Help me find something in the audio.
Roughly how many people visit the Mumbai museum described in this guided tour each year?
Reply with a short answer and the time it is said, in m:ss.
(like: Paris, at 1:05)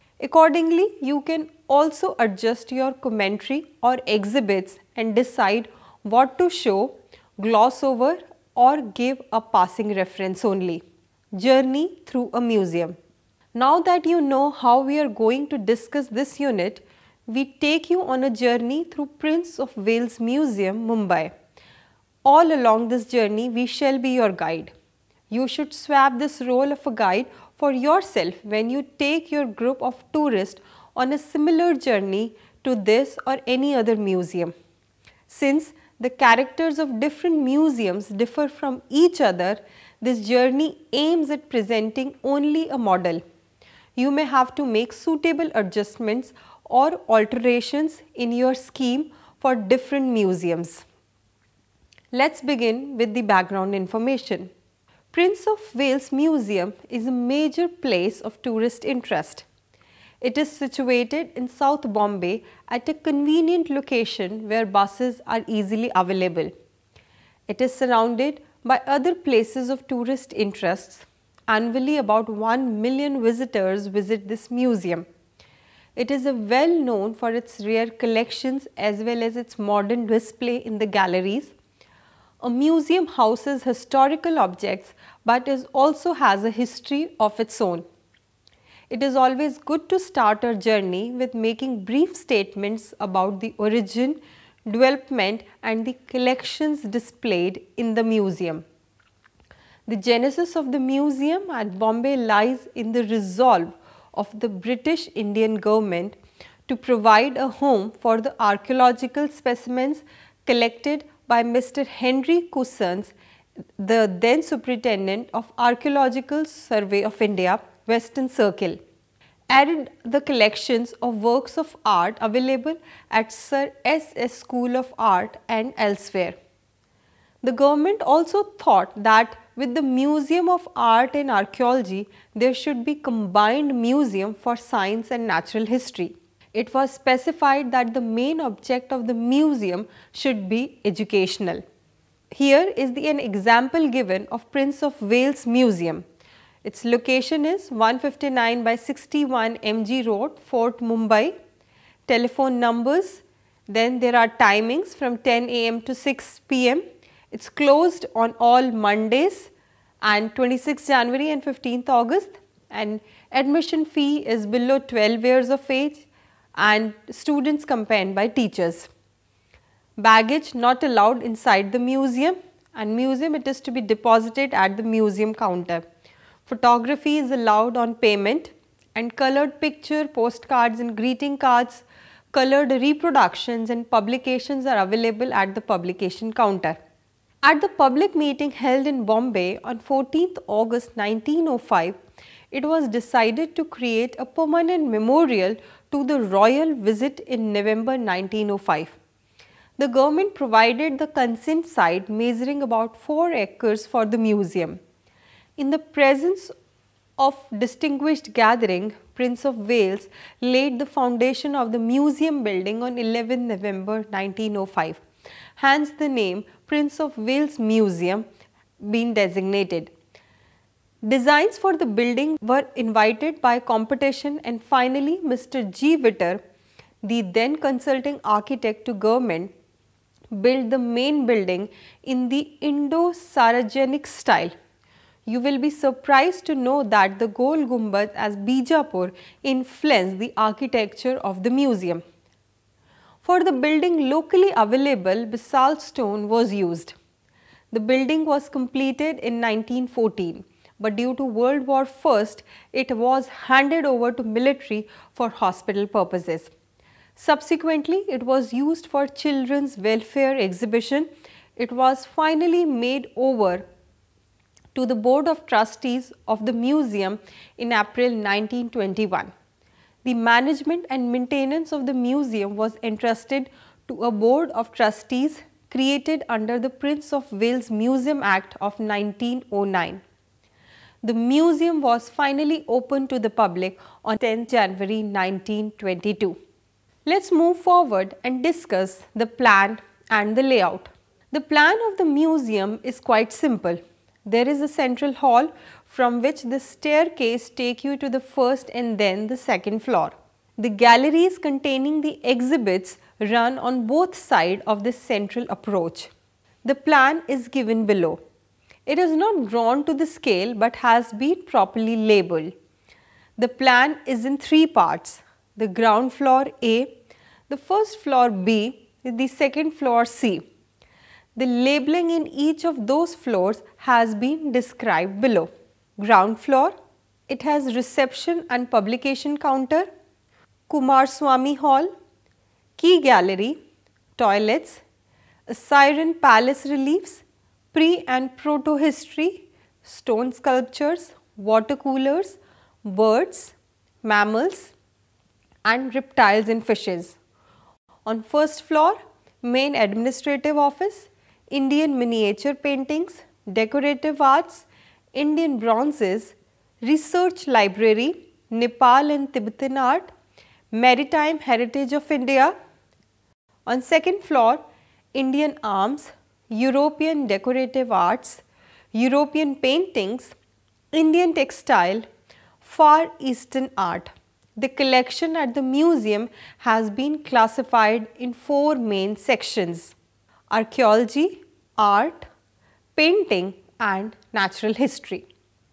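About 1 million, at 1:11.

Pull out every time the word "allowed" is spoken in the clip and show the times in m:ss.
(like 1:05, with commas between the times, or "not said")
2:50, 2:57.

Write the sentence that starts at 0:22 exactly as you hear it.
All along this journey, we shall be your guide.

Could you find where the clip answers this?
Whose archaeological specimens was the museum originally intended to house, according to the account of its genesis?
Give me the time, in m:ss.
1:51.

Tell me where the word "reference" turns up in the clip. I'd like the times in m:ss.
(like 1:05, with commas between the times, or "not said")
0:09.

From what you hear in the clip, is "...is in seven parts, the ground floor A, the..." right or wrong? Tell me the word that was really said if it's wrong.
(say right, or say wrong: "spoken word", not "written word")
wrong: "three", not "seven".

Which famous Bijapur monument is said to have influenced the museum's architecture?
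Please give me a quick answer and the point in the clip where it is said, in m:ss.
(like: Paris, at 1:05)
Gol Gumbad, at 3:57.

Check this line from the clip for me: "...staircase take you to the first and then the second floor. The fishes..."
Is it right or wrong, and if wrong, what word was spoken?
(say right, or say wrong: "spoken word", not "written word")
wrong: "galleries", not "fishes".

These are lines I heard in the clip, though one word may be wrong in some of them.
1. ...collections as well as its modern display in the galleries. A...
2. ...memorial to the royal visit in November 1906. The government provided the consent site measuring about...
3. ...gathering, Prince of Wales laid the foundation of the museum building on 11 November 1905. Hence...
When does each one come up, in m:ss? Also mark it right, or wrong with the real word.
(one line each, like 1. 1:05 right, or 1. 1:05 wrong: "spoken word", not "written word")
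1. 1:18 right
2. 3:14 wrong: "1905", not "1906"
3. 3:28 right.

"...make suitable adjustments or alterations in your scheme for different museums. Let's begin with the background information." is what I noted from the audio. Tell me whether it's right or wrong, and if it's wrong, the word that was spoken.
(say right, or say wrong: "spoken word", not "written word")
right.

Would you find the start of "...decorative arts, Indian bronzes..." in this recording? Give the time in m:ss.
5:53.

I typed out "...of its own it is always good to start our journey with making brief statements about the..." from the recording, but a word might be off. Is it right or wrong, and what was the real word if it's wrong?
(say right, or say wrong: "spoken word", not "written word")
right.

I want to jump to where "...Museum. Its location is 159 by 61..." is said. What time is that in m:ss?
2:25.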